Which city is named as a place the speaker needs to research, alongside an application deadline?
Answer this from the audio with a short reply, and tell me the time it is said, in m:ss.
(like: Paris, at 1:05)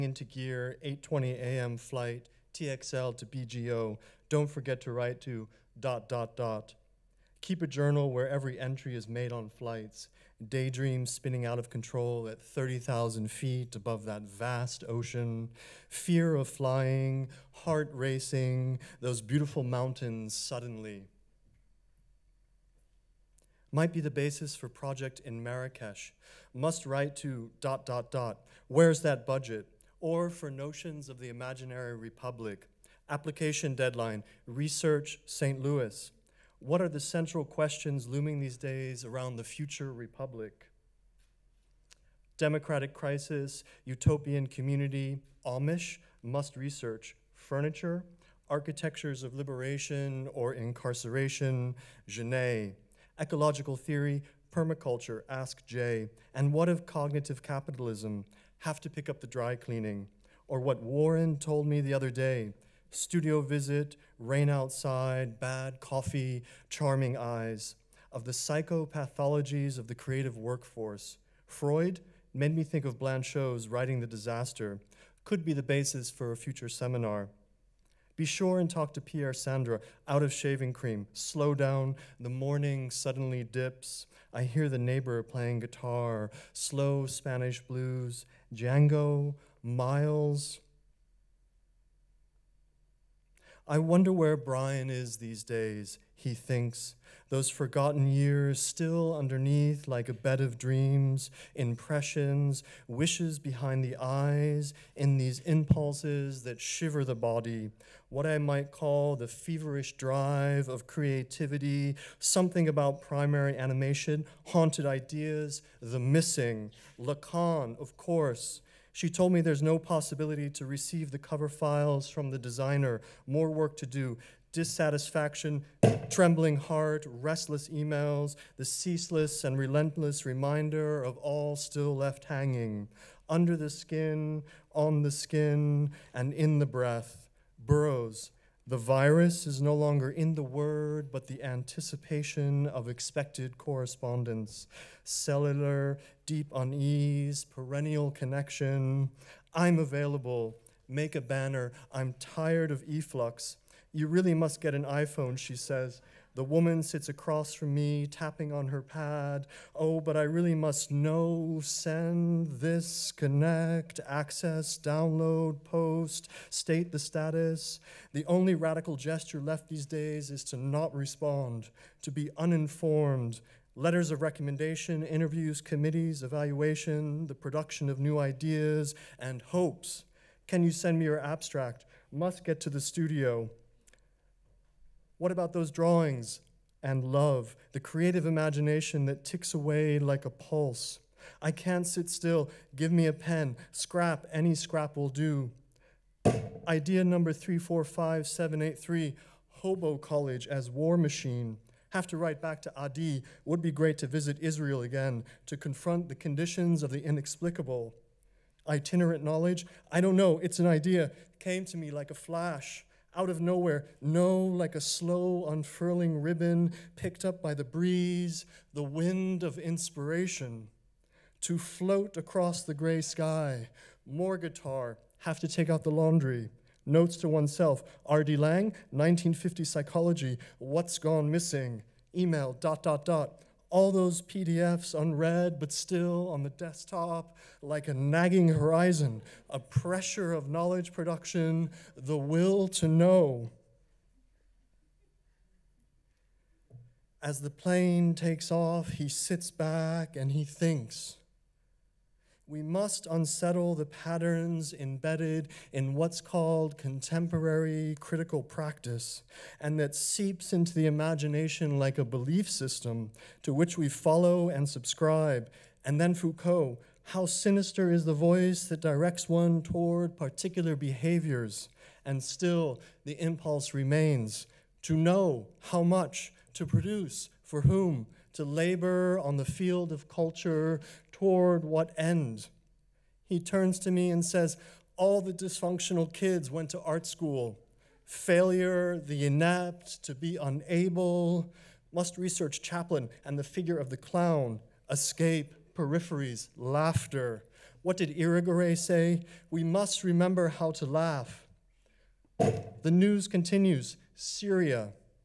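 St. Louis, at 0:35.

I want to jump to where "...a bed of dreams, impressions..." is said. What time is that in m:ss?
1:40.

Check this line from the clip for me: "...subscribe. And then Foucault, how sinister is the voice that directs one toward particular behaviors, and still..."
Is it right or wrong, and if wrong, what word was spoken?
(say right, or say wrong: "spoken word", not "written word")
right.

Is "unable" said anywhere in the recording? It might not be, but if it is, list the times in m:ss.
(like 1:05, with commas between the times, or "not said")
4:50.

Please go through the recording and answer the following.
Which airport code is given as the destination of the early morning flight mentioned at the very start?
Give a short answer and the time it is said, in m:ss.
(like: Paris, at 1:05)
BGO, at 0:03.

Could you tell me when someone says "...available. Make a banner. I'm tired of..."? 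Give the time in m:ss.
2:29.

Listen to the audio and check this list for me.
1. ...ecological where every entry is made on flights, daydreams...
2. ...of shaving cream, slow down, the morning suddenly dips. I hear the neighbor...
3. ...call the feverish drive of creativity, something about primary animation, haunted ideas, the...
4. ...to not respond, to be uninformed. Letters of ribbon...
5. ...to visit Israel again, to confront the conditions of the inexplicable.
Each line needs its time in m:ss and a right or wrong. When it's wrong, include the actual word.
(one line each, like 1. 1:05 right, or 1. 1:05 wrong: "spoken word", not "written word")
1. 0:07 wrong: "journal", not "ecological"
2. 1:20 right
3. 1:48 right
4. 2:50 wrong: "recommendation", not "ribbon"
5. 3:23 right.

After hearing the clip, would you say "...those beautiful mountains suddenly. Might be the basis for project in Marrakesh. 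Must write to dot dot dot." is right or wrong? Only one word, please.
right.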